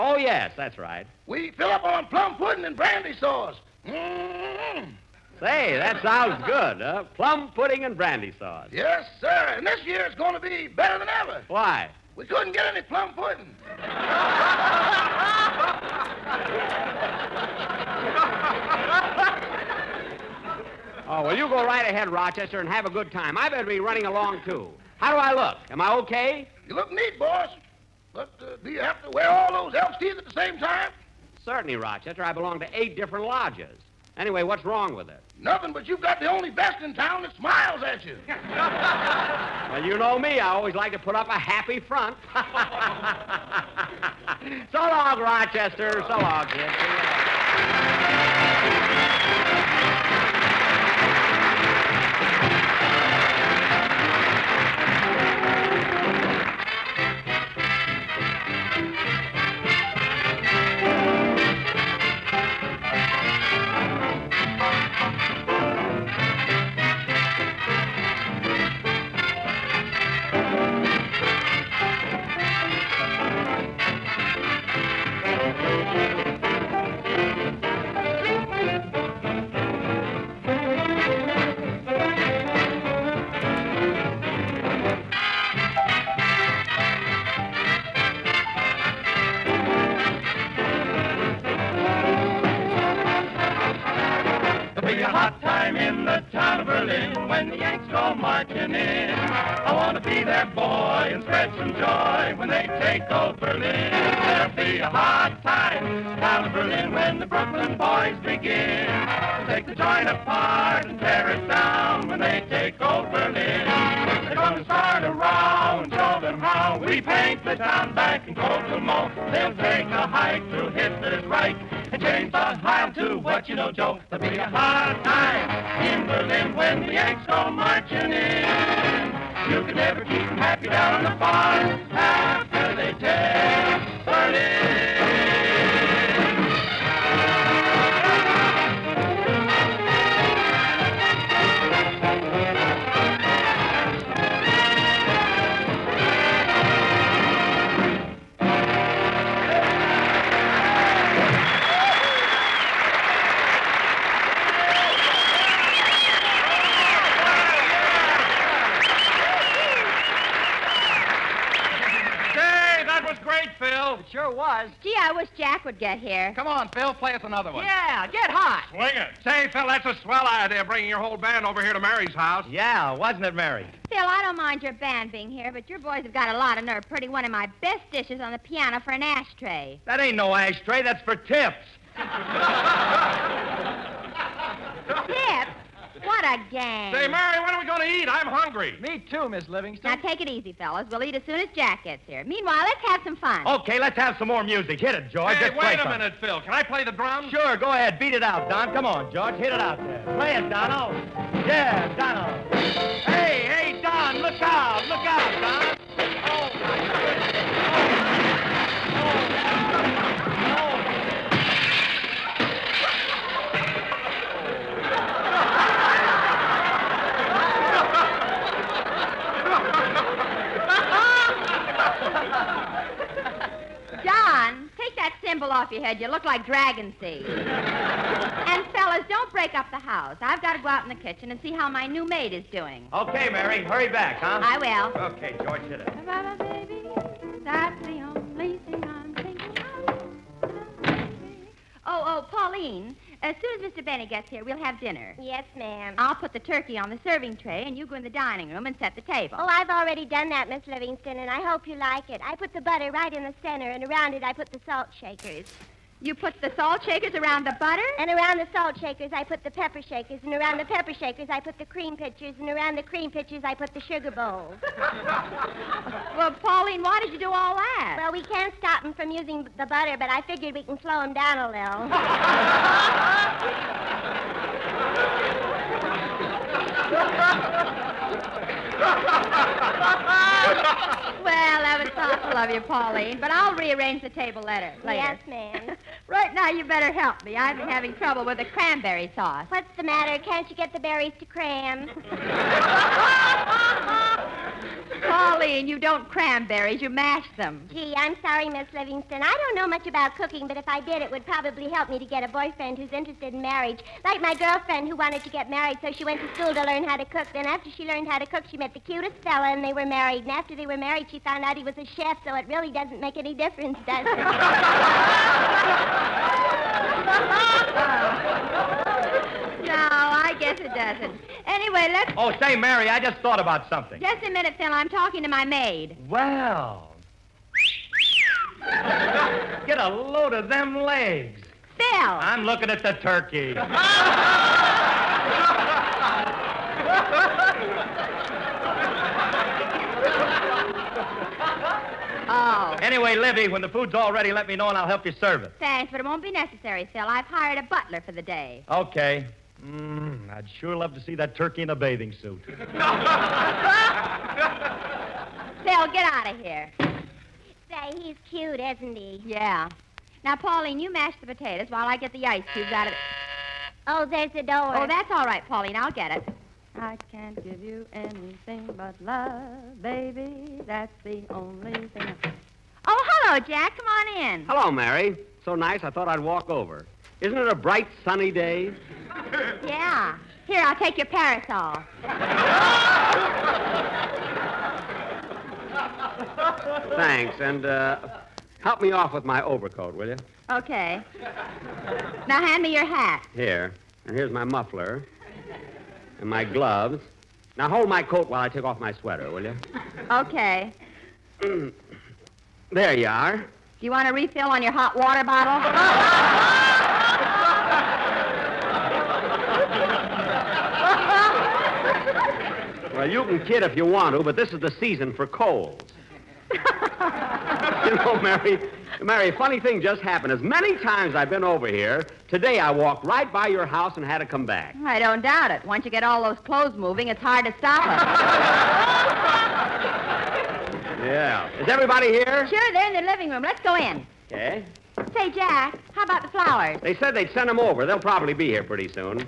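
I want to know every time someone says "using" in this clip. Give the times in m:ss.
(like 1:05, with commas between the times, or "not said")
4:29.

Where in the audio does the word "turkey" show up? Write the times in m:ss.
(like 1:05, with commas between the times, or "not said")
4:06, 5:32, 5:51.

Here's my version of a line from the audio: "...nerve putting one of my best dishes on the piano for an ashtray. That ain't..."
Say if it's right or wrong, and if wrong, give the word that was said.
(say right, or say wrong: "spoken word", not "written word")
right.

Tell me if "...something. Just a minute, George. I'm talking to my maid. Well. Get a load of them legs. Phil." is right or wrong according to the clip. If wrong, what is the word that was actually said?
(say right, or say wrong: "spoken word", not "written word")
wrong: "Phil", not "George".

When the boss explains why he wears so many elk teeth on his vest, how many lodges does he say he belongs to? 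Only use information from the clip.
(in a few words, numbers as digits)
8.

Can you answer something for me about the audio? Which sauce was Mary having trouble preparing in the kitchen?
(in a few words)
Cranberry sauce.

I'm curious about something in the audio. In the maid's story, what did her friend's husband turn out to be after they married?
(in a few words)
A chef.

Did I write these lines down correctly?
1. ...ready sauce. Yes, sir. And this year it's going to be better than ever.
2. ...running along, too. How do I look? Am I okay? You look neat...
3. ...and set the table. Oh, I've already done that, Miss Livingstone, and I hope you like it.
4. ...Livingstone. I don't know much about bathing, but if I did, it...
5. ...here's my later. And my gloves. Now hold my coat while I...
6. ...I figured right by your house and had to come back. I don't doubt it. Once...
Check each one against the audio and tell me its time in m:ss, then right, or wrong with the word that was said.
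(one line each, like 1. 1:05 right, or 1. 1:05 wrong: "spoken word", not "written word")
1. 0:07 wrong: "brandy", not "ready"
2. 0:23 right
3. 4:08 right
4. 4:58 wrong: "cooking", not "bathing"
5. 6:34 wrong: "muffler", not "later"
6. 7:02 wrong: "walked", not "figured".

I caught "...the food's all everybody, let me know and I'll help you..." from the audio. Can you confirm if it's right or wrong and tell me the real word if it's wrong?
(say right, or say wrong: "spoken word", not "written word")
wrong: "ready", not "everybody".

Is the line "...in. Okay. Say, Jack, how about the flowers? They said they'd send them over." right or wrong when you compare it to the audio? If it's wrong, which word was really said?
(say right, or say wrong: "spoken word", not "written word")
right.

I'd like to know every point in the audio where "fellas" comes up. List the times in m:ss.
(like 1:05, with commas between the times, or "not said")
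3:10, 3:48, 5:09.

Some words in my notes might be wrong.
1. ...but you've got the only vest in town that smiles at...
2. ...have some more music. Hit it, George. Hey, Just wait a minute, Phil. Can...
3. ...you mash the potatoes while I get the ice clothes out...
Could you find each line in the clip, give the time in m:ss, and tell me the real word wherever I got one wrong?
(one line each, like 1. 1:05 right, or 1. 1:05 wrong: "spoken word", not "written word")
1. 0:35 right
2. 3:13 right
3. 6:00 wrong: "cubes", not "clothes".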